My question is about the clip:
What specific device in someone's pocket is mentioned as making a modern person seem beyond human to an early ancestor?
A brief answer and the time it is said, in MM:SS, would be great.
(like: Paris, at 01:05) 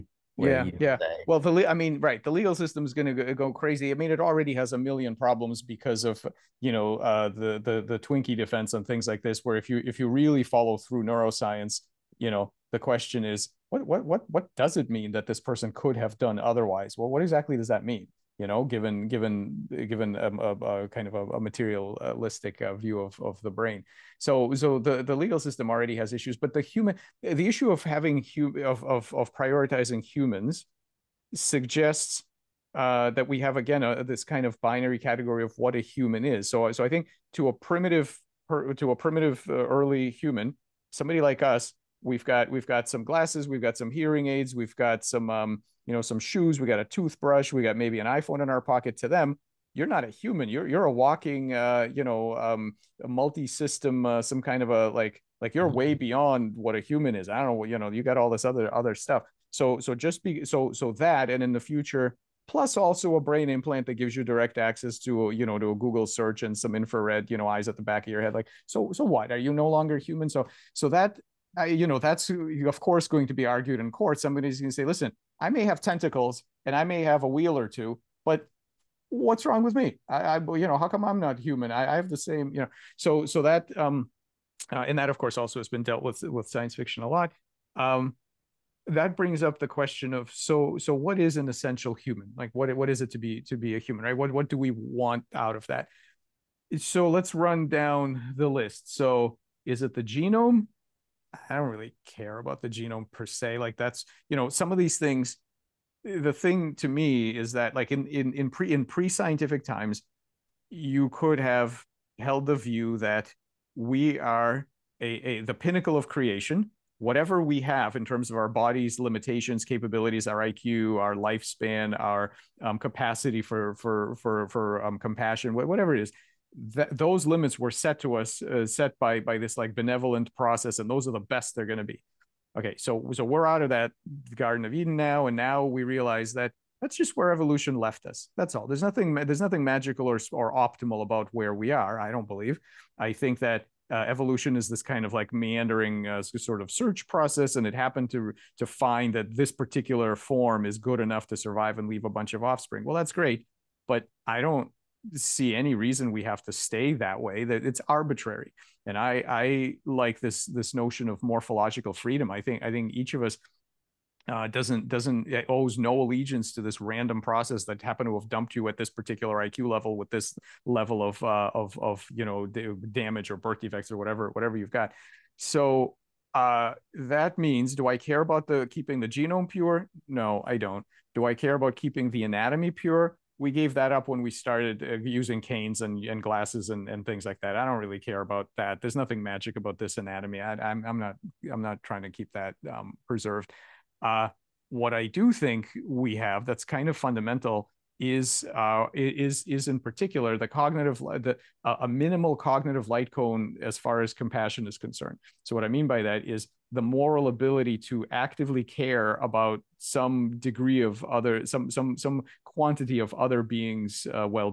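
iPhone, at 00:48.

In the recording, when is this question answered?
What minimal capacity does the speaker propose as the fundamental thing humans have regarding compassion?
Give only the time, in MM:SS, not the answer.
03:22.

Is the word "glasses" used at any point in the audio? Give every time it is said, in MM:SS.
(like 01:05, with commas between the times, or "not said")
00:43, 03:06.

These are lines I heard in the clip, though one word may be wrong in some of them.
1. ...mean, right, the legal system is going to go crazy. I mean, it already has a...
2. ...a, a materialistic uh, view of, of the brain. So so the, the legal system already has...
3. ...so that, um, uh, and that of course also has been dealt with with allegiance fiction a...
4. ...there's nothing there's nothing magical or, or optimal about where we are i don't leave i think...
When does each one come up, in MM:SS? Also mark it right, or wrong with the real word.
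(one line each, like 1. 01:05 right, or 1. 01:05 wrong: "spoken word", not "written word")
1. 00:01 right
2. 00:21 right
3. 01:23 wrong: "science", not "allegiance"
4. 02:18 wrong: "believe", not "leave".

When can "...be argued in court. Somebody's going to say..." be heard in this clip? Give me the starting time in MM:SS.
01:13.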